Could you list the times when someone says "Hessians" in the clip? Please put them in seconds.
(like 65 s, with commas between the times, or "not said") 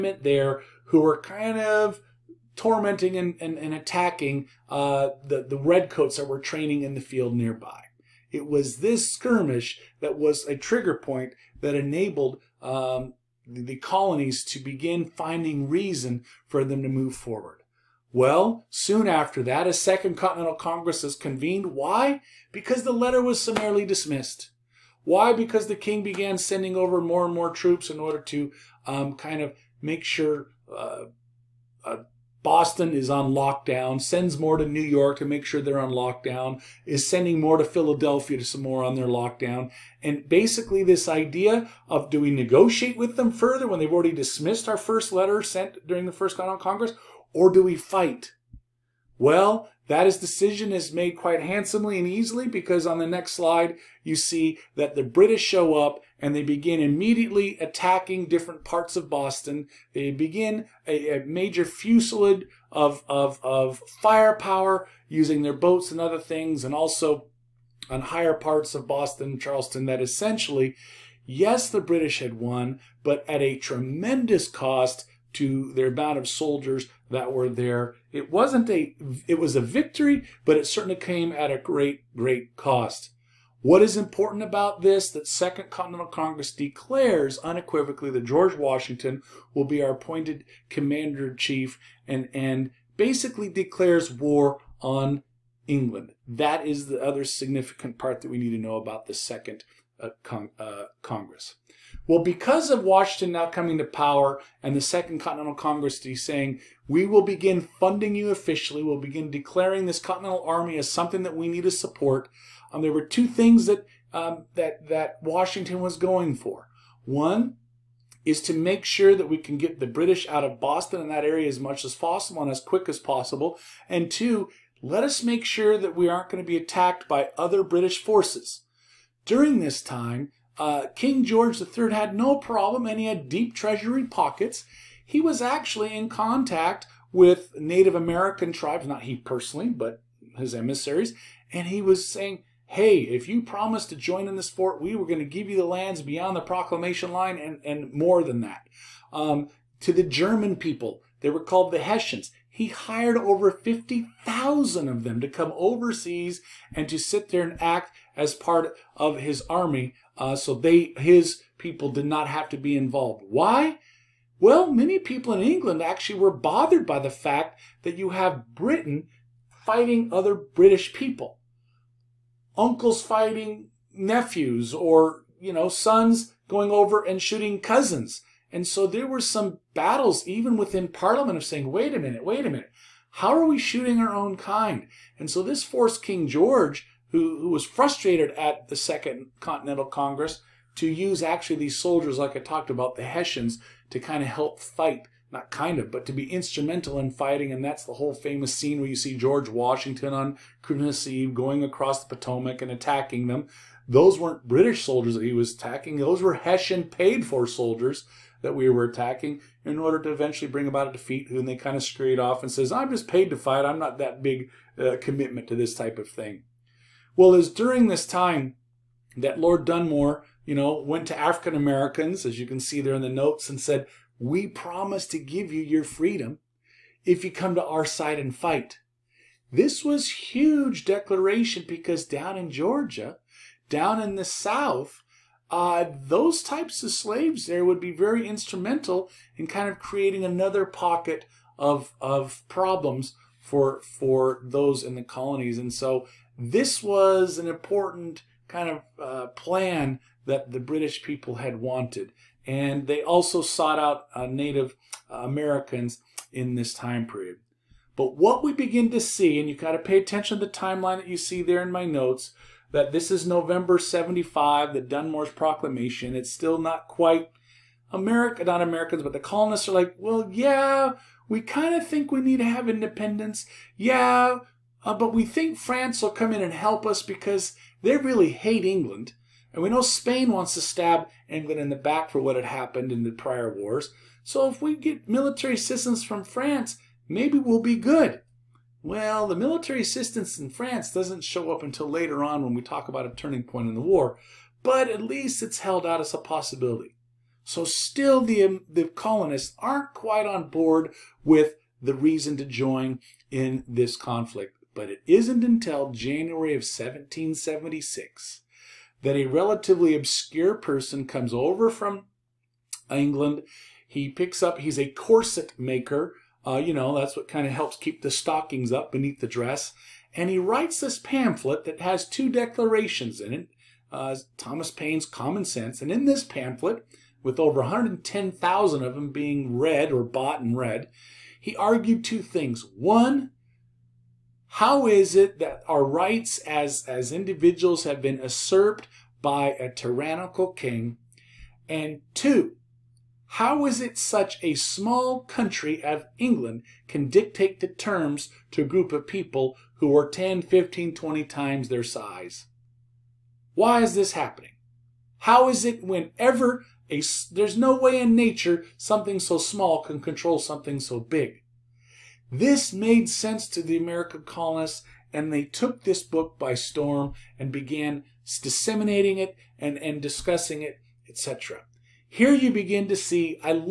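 151 s, 193 s, 206 s.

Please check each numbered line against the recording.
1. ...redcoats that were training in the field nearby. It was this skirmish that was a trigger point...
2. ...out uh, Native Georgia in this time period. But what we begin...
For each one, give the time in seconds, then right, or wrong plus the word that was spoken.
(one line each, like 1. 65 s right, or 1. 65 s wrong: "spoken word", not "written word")
1. 5 s right
2. 253 s wrong: "Americans", not "Georgia".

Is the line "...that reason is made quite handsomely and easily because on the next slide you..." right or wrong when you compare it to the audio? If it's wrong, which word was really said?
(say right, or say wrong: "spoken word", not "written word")
wrong: "decision", not "reason".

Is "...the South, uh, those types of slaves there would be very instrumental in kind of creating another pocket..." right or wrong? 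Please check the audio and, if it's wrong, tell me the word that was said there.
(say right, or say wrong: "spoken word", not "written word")
right.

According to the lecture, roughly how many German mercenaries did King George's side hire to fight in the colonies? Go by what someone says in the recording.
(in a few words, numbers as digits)
50,000.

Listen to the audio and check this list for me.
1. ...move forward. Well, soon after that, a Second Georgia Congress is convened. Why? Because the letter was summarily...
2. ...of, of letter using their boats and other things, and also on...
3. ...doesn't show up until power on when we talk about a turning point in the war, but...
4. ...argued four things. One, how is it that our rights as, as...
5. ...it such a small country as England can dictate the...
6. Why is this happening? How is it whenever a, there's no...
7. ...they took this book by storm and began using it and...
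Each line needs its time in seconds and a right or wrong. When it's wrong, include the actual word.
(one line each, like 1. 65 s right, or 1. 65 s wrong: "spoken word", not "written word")
1. 16 s wrong: "Continental", not "Georgia"
2. 63 s wrong: "firepower", not "letter"
3. 290 s wrong: "later", not "power"
4. 331 s wrong: "two", not "four"
5. 343 s right
6. 353 s right
7. 365 s wrong: "disseminating", not "using".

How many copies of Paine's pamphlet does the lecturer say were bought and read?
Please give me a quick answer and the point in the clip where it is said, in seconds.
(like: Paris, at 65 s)
Over 110,000, at 327 s.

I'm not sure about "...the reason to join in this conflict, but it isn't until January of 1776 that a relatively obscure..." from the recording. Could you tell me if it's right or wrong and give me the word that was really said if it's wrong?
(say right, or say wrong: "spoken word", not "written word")
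right.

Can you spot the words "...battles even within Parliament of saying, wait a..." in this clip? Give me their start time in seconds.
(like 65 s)
179 s.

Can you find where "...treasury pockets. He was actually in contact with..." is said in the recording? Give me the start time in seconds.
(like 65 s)
133 s.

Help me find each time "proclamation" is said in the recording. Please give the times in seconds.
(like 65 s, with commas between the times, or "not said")
146 s, 265 s.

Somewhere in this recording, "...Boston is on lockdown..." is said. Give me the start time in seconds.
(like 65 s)
32 s.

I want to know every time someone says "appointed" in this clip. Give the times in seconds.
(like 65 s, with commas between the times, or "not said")
89 s.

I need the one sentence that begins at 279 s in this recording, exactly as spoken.
And we know Spain wants to stab England in the back for what had happened in the prior wars.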